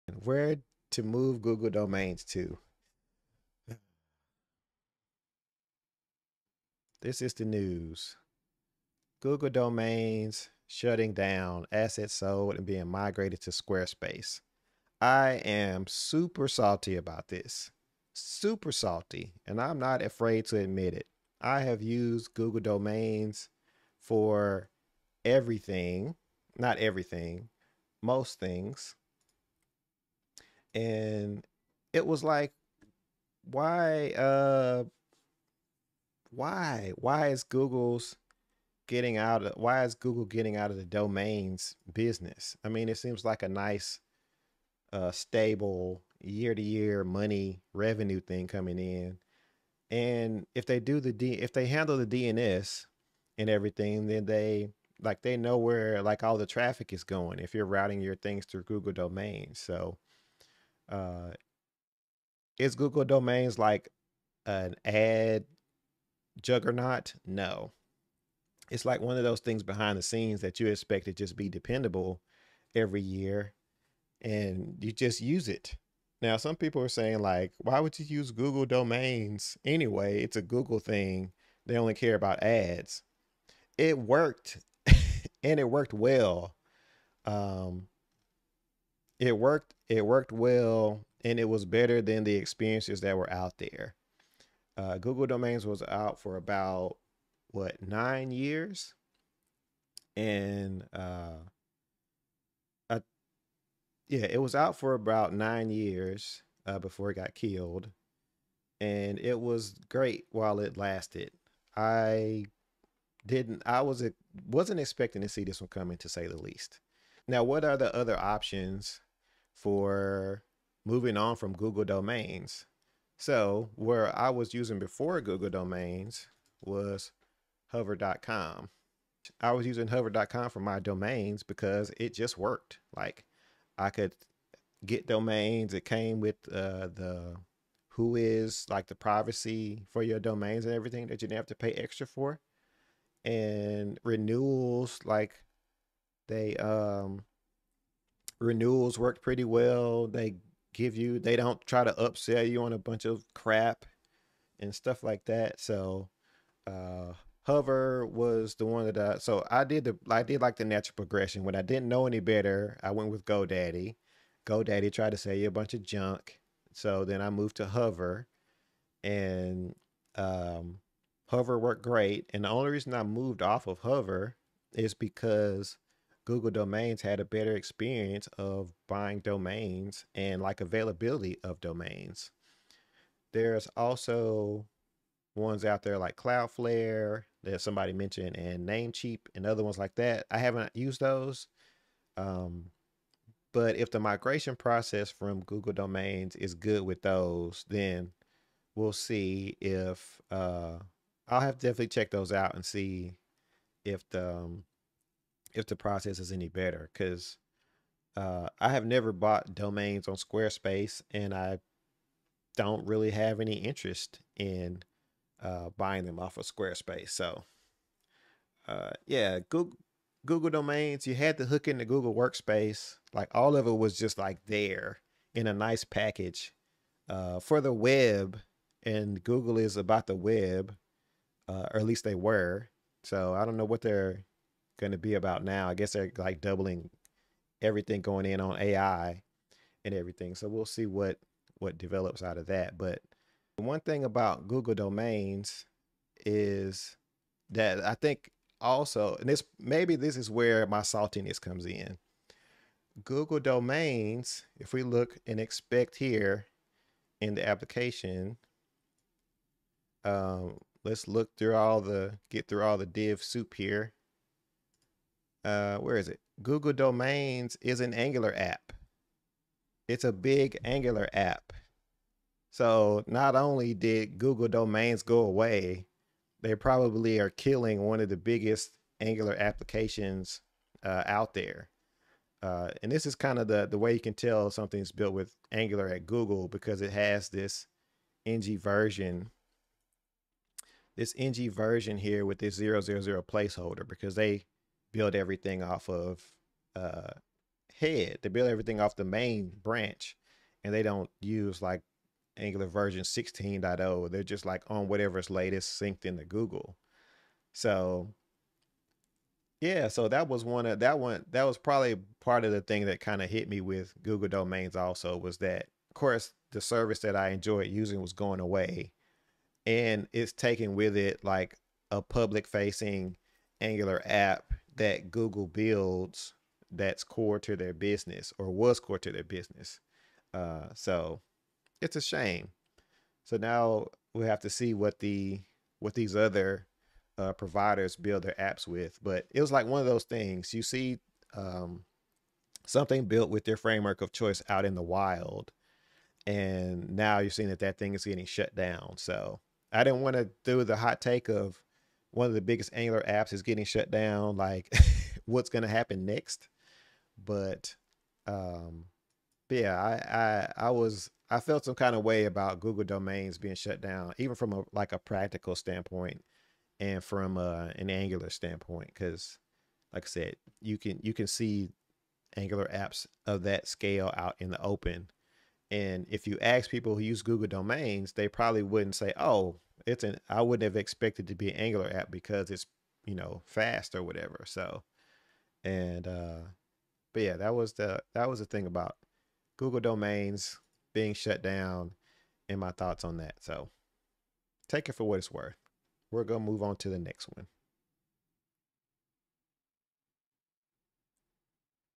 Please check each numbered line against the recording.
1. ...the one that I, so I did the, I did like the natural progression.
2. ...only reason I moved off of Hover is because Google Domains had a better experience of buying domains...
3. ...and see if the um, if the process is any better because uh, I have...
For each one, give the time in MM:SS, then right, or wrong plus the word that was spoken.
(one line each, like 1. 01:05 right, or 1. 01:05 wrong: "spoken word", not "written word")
1. 02:38 right
2. 02:52 right
3. 03:22 right.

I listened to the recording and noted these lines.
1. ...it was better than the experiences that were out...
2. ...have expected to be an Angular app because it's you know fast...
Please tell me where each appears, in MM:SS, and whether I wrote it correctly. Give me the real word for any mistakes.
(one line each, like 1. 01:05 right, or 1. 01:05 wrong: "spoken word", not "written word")
1. 01:31 right
2. 06:20 right.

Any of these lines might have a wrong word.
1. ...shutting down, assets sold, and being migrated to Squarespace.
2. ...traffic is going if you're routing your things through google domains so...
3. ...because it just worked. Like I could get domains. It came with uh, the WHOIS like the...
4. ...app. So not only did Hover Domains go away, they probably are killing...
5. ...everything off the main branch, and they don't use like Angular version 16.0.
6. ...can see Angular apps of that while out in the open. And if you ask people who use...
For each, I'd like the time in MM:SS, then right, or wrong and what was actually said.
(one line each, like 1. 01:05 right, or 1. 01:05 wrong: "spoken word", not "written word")
1. 00:10 right
2. 00:56 right
3. 02:11 right
4. 04:31 wrong: "Google", not "Hover"
5. 04:58 right
6. 06:11 wrong: "scale", not "while".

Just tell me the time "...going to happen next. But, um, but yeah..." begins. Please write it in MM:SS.
05:55.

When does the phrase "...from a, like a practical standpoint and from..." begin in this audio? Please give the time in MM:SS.
06:04.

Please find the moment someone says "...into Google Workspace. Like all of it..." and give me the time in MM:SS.
03:41.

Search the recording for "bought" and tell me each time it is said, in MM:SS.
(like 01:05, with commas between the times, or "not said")
03:29.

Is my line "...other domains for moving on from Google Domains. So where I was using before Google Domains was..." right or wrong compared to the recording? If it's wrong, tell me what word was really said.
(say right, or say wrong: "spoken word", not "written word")
wrong: "options", not "domains".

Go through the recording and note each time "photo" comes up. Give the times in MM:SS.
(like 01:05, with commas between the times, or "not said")
not said.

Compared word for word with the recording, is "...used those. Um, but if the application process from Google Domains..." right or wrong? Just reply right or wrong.
wrong.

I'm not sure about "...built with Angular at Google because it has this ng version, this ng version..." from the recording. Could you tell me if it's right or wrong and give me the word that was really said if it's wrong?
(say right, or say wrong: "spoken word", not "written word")
right.